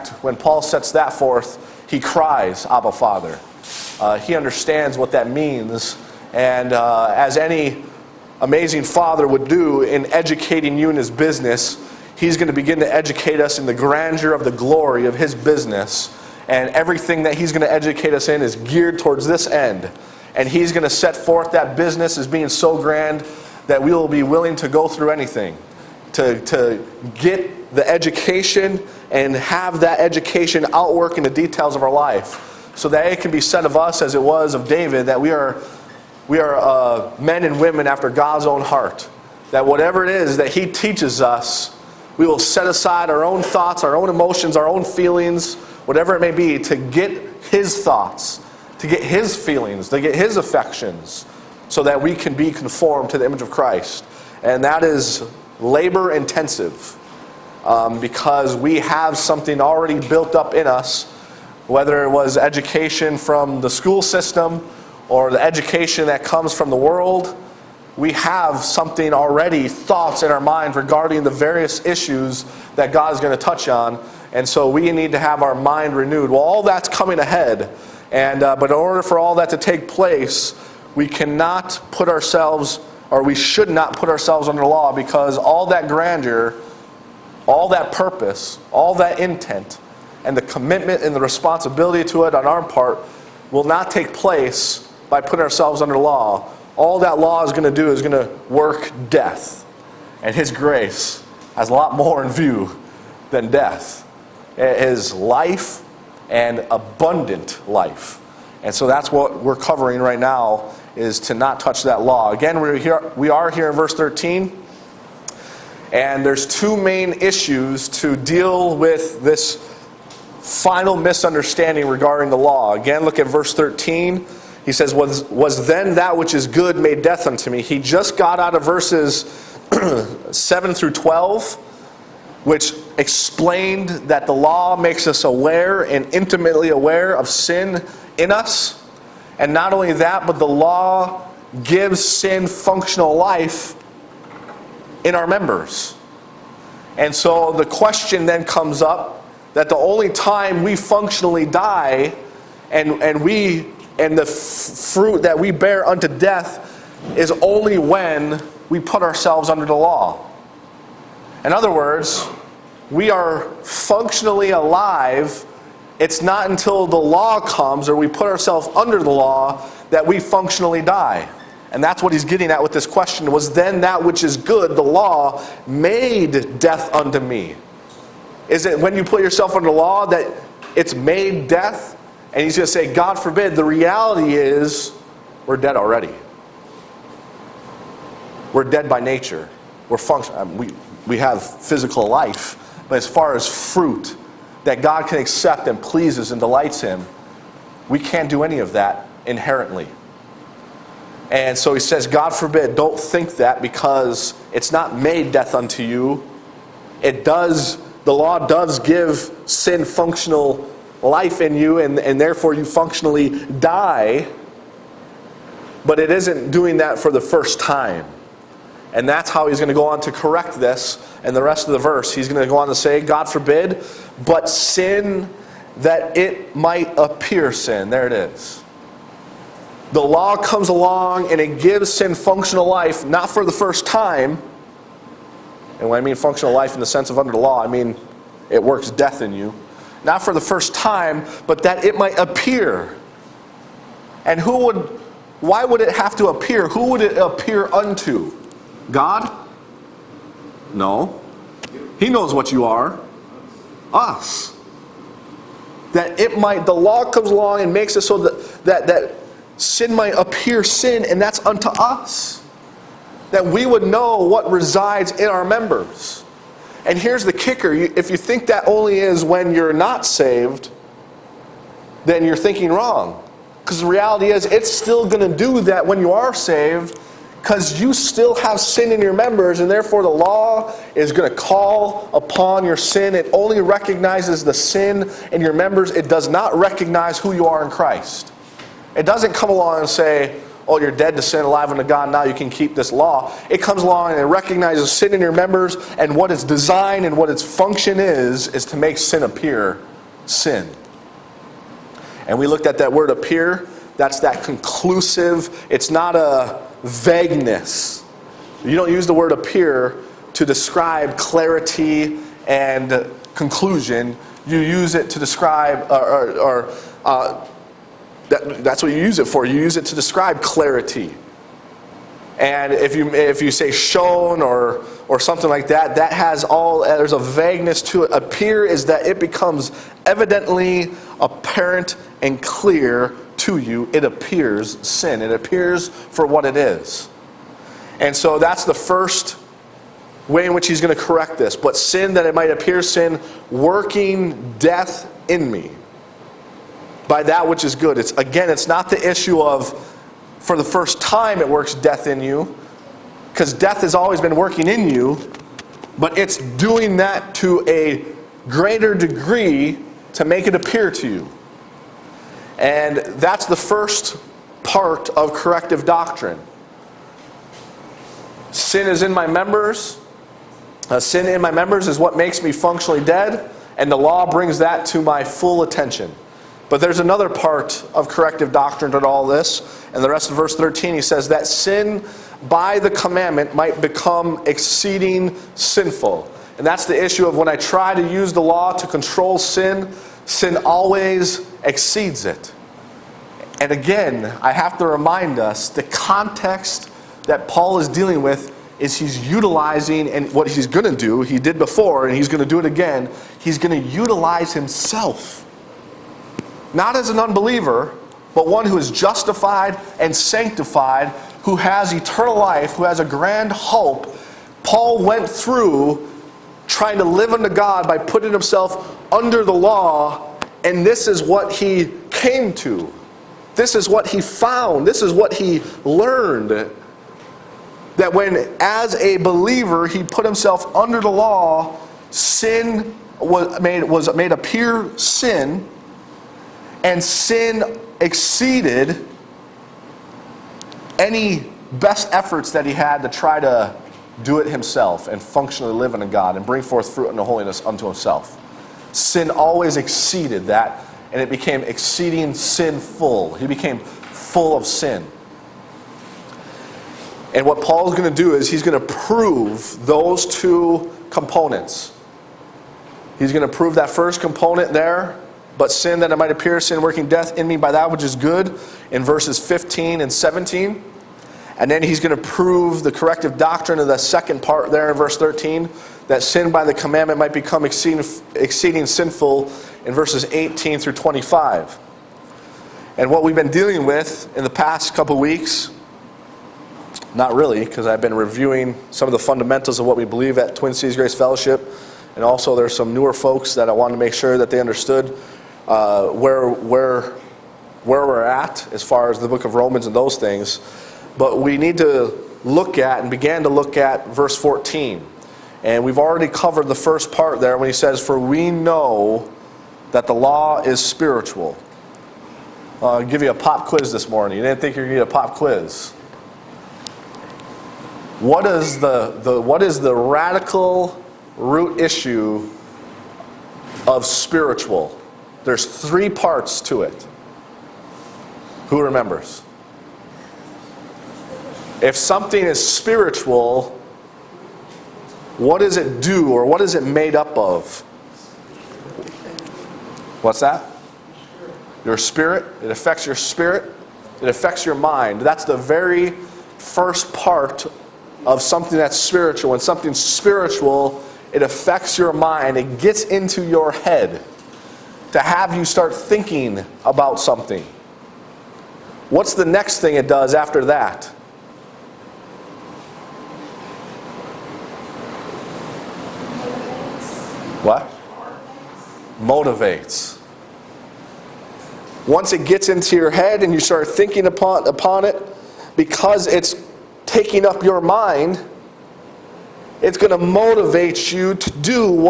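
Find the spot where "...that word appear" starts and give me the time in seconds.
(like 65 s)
302 s.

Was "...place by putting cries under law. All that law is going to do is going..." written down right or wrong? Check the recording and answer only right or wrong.
wrong.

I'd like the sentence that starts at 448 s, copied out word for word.
Sin always exceeded that, and it became exceeding sinful.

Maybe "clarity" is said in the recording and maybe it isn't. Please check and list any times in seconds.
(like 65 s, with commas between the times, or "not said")
311 s, 320 s.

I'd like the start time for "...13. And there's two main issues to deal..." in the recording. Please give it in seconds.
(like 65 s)
113 s.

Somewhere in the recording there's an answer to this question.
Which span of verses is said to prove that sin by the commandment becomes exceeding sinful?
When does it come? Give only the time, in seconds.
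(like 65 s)
480 s.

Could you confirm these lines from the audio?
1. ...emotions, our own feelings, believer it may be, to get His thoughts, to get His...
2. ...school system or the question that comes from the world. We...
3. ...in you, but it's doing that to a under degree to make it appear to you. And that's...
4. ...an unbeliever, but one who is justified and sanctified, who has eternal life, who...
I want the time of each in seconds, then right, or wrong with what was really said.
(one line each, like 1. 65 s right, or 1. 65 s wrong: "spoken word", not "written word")
1. 44 s wrong: "whatever", not "believer"
2. 63 s wrong: "education", not "question"
3. 354 s wrong: "greater", not "under"
4. 407 s right.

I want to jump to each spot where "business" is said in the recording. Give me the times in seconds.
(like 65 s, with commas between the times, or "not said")
11 s, 15 s, 21 s.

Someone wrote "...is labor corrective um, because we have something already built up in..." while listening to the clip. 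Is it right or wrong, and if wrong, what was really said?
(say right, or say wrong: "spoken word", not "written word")
wrong: "intensive", not "corrective".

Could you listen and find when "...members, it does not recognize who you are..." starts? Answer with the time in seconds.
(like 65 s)
285 s.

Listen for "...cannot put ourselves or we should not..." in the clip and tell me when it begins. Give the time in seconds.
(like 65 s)
81 s.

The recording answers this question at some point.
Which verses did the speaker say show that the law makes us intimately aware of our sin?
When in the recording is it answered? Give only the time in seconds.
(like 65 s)
130 s.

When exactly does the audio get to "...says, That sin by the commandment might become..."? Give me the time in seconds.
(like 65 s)
381 s.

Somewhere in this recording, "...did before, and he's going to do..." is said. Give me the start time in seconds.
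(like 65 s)
401 s.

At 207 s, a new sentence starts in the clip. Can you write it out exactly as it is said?
It does, the law does give sin functional life in you, and, and therefore you functionally die.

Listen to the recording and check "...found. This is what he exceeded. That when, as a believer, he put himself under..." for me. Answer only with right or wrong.
wrong.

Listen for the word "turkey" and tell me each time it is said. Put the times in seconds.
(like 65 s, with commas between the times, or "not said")
not said.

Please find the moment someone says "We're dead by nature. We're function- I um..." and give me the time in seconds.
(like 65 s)
188 s.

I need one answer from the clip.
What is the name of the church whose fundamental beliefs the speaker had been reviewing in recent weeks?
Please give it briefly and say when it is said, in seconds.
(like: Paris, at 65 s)
Twin Cities Grace Fellowship, at 490 s.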